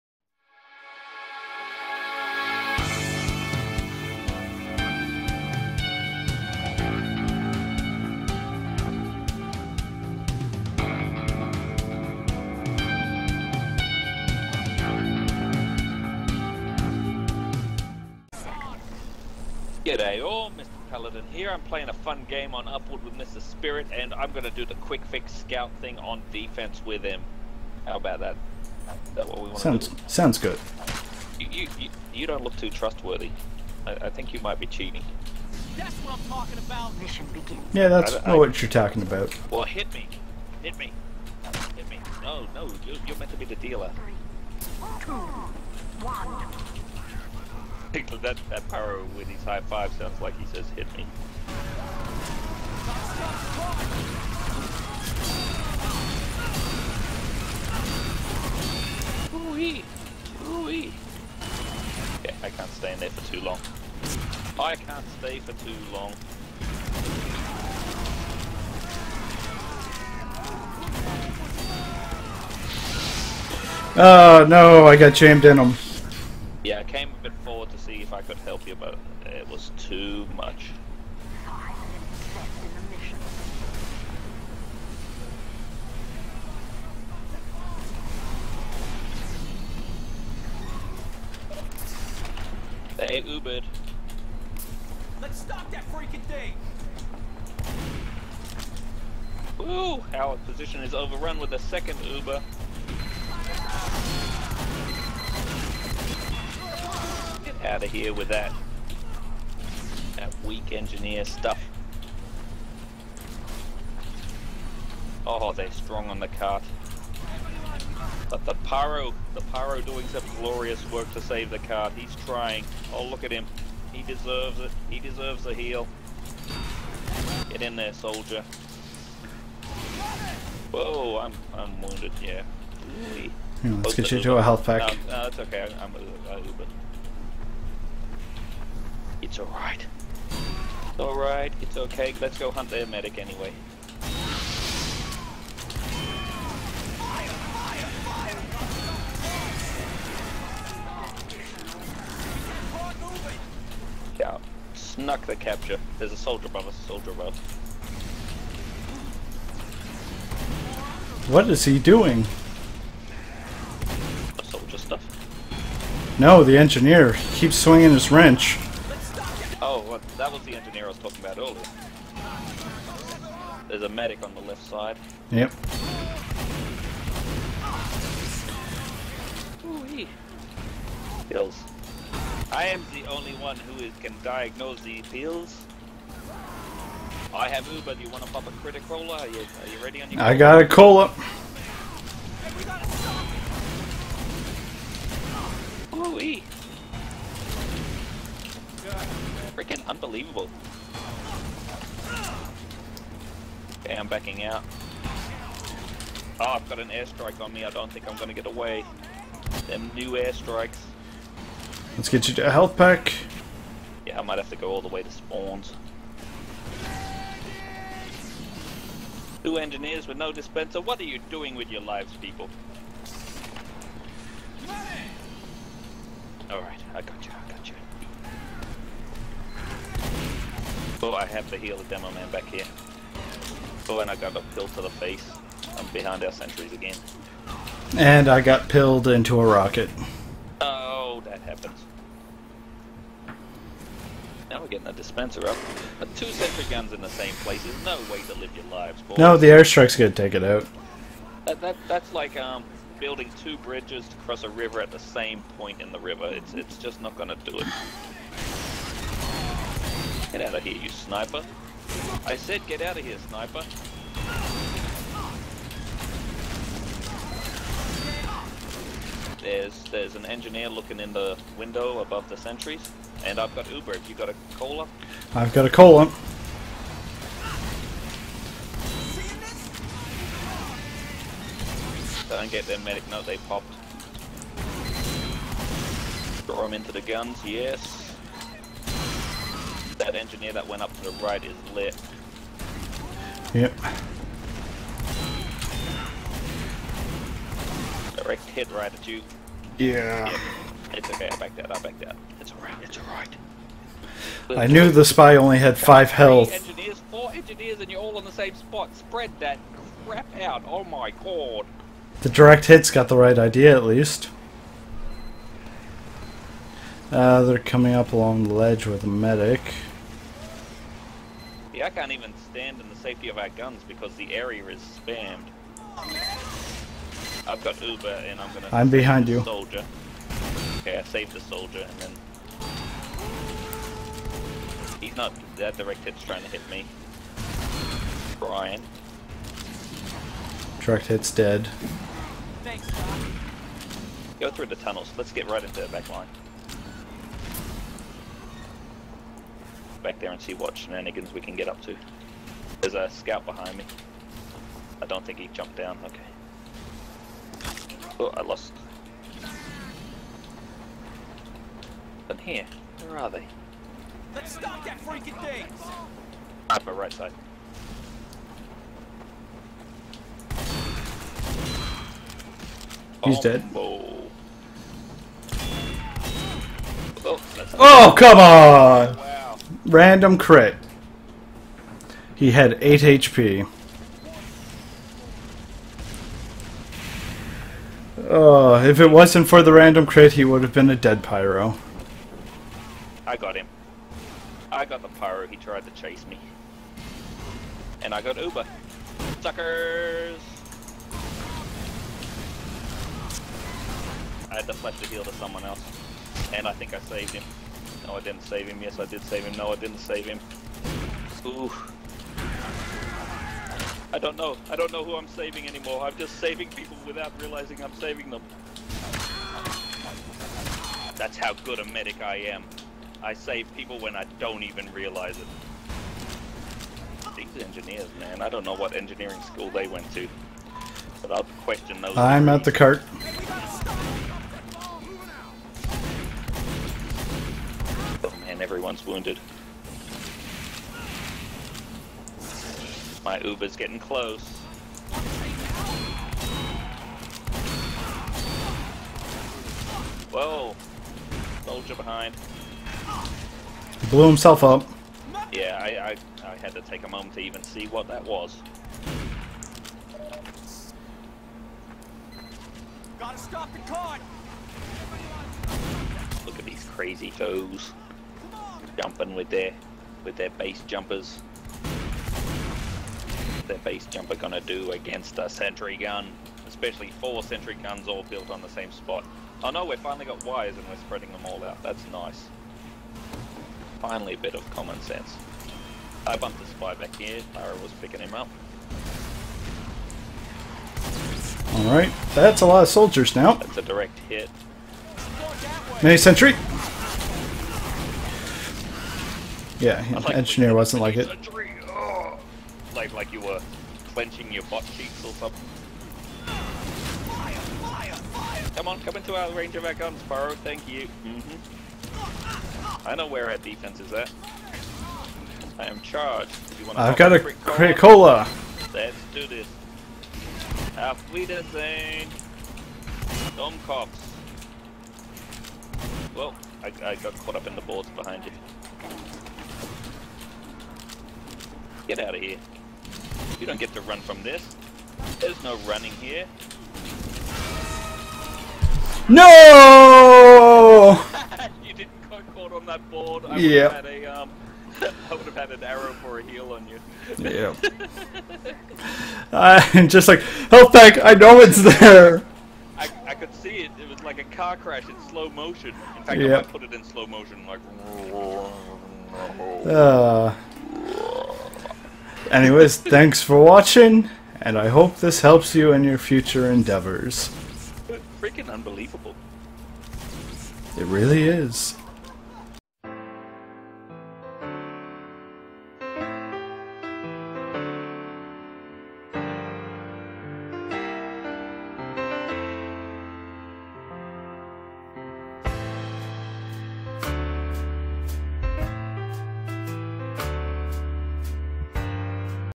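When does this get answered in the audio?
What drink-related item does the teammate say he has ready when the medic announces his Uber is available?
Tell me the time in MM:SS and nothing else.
03:08.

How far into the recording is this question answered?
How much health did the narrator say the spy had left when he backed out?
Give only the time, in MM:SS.
05:05.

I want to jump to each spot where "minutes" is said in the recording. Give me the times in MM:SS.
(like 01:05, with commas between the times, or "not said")
01:32.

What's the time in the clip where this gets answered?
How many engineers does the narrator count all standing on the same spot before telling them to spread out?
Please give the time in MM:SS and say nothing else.
05:07.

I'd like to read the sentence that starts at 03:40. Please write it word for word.
What are you doing with your lives, people?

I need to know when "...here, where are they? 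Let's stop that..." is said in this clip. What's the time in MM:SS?
06:02.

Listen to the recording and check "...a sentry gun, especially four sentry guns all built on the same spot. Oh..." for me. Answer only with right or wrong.
right.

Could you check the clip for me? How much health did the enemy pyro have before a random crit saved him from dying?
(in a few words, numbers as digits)
8 HP.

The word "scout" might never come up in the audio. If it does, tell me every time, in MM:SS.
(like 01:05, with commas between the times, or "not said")
00:25, 05:53.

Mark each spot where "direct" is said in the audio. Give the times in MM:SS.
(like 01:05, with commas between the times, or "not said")
04:58, 05:12, 05:35, 05:40, 08:13.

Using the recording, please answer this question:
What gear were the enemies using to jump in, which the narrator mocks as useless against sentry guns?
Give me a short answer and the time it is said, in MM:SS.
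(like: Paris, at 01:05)
Base jumpers, at 07:50.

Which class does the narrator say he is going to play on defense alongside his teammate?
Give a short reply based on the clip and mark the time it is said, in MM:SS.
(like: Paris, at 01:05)
Quick fix, at 00:24.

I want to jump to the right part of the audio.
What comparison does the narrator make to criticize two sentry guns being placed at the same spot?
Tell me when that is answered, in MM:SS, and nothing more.
04:12.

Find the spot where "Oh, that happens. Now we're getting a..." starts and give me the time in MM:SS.
04:00.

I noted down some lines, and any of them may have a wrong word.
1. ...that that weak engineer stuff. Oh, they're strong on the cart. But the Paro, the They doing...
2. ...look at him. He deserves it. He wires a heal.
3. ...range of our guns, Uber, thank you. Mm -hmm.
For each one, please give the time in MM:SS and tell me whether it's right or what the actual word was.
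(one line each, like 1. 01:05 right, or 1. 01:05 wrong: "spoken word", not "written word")
1. 01:48 wrong: "Paro", not "They"
2. 02:03 wrong: "deserves", not "wires"
3. 08:29 wrong: "Faro", not "Uber".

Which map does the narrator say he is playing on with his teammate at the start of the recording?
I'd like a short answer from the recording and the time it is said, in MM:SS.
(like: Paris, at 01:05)
Upward, at 00:22.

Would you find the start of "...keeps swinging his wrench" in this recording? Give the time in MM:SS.
02:47.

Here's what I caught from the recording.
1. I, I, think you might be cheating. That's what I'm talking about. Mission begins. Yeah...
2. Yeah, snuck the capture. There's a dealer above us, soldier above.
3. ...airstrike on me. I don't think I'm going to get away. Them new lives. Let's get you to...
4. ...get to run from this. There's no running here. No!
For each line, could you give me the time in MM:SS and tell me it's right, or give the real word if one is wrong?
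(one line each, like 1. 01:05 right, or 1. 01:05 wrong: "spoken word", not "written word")
1. 00:33 right
2. 02:34 wrong: "soldier", not "dealer"
3. 03:26 wrong: "airstrikes", not "lives"
4. 08:53 right.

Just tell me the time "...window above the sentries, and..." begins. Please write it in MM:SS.
04:31.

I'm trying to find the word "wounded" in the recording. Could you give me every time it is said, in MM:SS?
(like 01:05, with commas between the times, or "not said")
02:11, 07:19.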